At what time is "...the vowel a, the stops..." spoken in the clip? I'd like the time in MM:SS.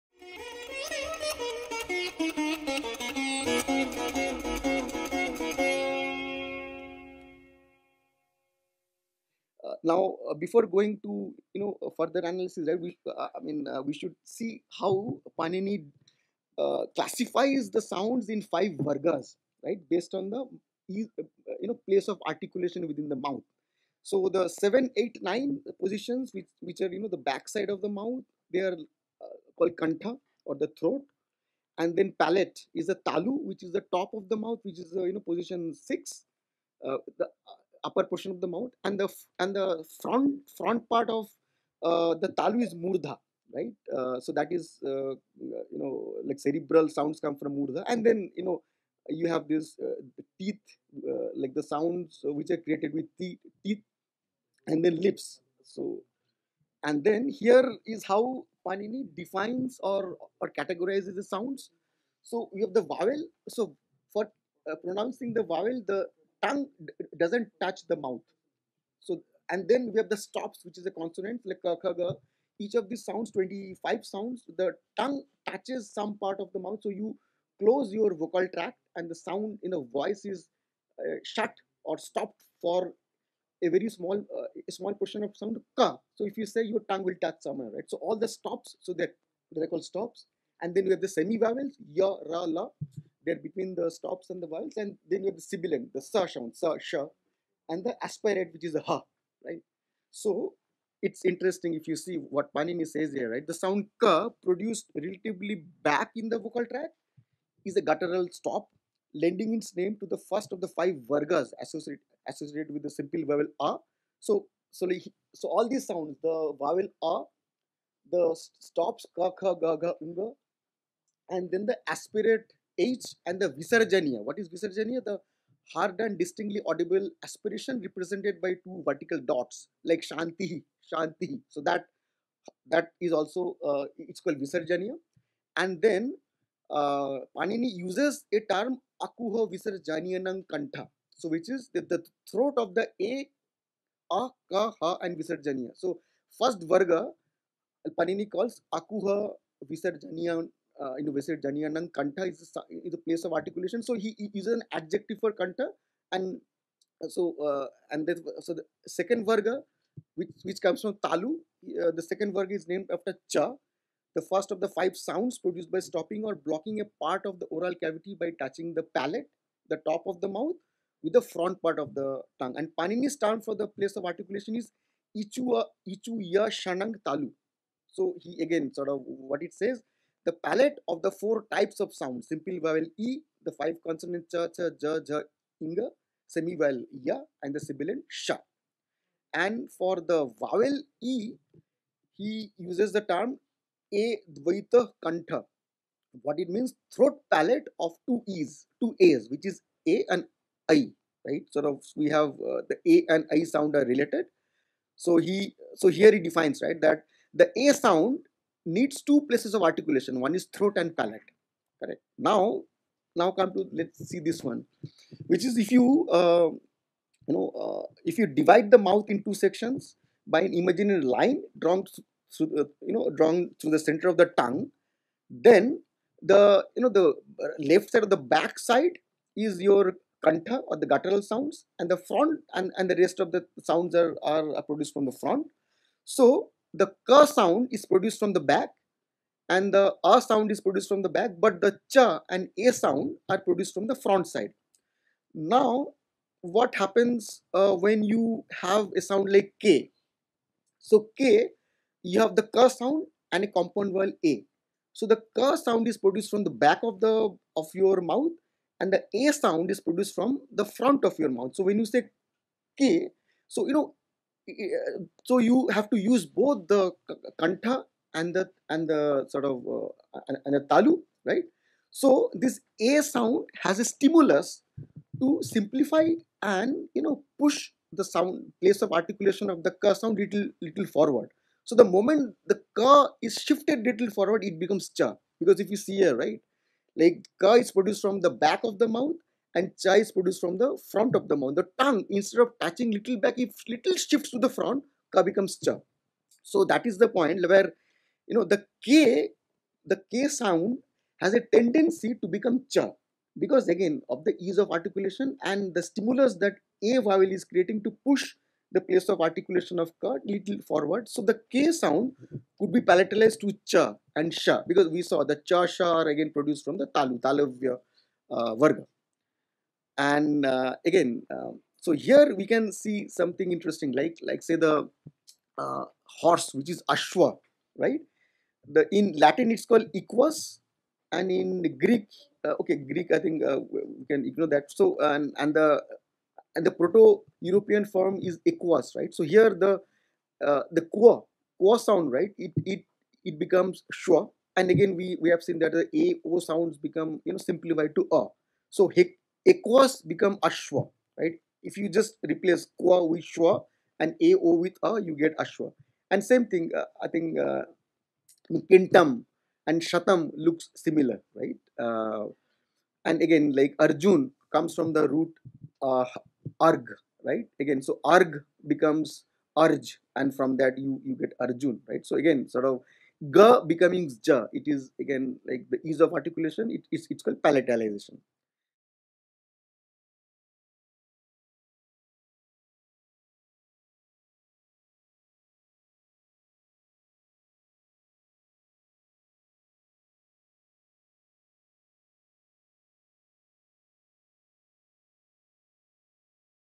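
01:56.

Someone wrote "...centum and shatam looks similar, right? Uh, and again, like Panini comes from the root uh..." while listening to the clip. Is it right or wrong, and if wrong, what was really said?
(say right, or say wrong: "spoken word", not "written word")
wrong: "Arjun", not "Panini".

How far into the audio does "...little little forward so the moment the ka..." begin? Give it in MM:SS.
04:40.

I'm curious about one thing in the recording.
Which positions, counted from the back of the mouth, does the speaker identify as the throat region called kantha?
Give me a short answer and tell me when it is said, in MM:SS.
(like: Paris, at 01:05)
7, 8, 9, at 00:24.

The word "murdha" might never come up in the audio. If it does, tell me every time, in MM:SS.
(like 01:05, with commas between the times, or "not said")
00:42, 00:47.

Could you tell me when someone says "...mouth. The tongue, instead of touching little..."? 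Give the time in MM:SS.
04:51.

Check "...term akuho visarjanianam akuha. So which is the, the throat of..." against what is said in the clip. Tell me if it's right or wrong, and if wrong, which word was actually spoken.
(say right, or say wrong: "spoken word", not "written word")
wrong: "kantha", not "akuha".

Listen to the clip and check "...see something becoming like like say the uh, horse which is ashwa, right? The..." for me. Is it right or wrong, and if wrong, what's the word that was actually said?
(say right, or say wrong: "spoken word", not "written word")
wrong: "interesting", not "becoming".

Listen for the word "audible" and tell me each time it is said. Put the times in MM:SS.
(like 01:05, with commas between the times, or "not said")
02:06.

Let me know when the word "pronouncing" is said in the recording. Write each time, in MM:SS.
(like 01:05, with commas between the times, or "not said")
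01:04.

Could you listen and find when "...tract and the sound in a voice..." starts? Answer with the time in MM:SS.
01:18.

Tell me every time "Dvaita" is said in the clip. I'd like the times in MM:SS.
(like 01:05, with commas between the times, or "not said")
03:14.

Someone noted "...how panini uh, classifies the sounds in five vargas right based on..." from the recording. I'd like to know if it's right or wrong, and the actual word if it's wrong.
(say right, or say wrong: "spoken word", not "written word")
right.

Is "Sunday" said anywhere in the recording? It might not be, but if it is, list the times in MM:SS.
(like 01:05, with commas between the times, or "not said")
not said.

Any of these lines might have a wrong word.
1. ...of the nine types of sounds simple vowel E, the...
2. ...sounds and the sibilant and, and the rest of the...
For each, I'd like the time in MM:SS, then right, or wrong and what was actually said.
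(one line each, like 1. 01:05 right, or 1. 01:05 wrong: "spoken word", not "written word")
1. 03:00 wrong: "four", not "nine"
2. 03:51 wrong: "front", not "sibilant".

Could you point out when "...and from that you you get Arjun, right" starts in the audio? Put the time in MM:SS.
06:10.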